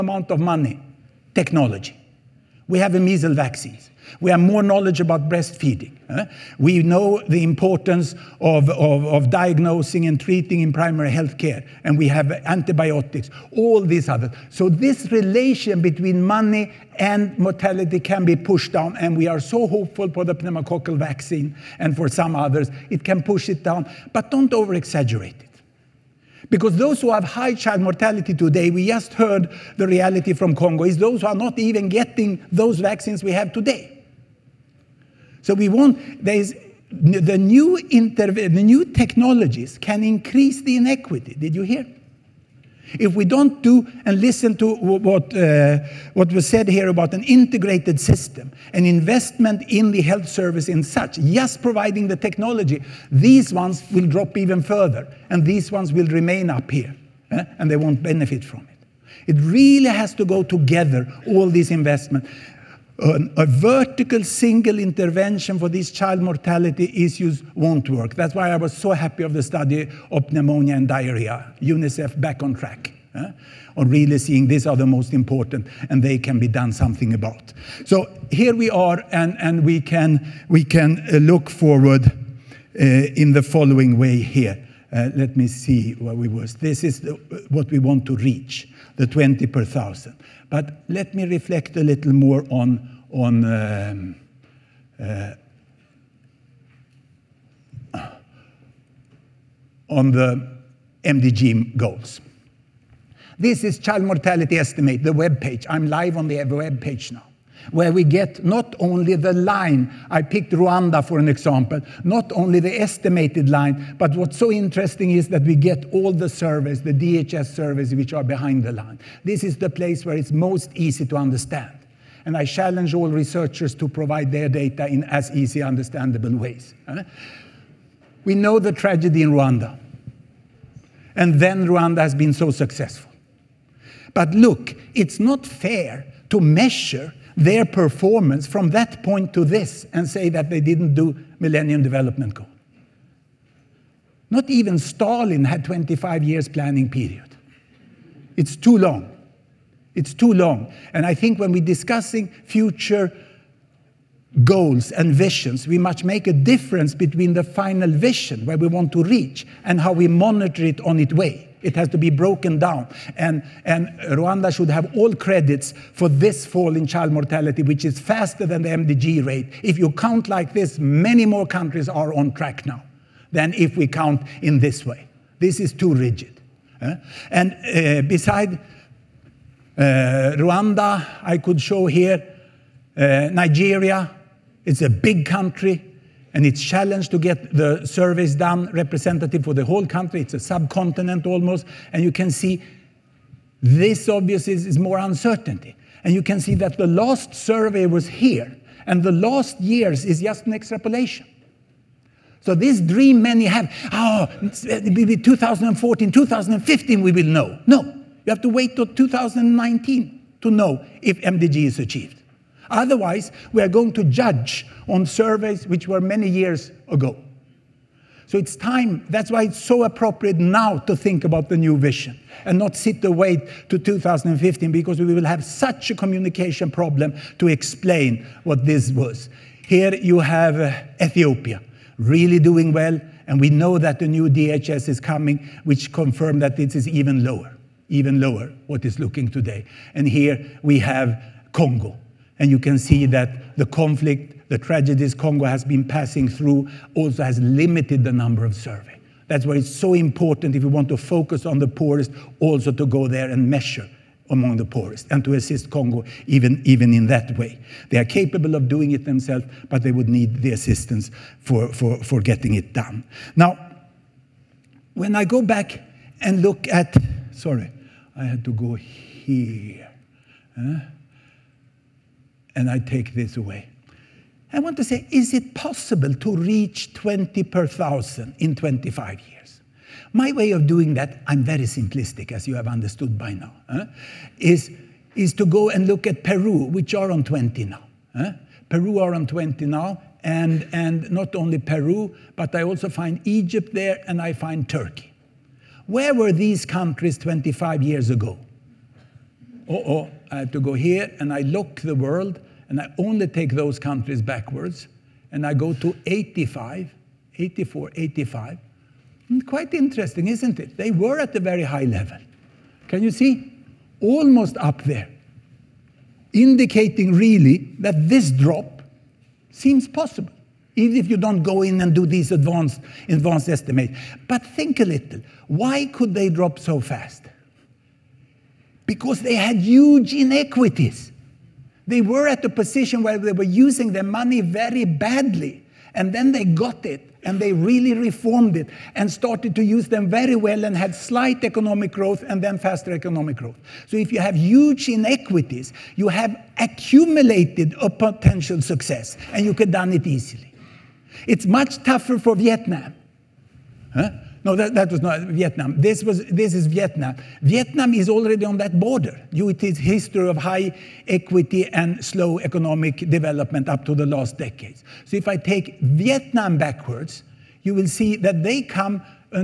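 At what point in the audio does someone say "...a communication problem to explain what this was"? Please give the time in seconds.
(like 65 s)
225 s.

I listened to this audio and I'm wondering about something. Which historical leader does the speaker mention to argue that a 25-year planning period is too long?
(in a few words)
Stalin.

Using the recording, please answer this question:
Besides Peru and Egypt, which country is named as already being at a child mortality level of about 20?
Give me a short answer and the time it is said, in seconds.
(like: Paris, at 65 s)
Turkey, at 294 s.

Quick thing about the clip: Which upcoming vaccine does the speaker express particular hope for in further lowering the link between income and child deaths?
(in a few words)
pneumococcal vaccine.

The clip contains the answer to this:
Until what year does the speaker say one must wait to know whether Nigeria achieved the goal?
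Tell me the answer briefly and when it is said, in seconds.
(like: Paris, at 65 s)
2019, at 208 s.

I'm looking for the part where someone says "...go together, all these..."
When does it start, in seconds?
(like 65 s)
60 s.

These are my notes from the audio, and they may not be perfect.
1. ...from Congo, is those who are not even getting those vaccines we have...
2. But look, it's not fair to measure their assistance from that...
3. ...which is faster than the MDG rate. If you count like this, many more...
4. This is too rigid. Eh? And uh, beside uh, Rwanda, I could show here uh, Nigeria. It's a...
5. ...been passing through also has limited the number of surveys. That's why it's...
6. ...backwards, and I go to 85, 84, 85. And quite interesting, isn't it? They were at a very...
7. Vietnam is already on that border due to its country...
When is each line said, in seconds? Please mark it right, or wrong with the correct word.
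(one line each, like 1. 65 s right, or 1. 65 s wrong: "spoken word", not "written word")
1. 30 s right
2. 134 s wrong: "performance", not "assistance"
3. 167 s right
4. 175 s right
5. 245 s right
6. 304 s right
7. 357 s wrong: "history", not "country".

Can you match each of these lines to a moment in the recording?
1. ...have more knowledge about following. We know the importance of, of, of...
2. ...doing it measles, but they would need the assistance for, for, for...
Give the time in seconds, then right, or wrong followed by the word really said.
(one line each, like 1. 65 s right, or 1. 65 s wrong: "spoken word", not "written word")
1. 4 s wrong: "breastfeeding", not "following"
2. 258 s wrong: "themselves", not "measles".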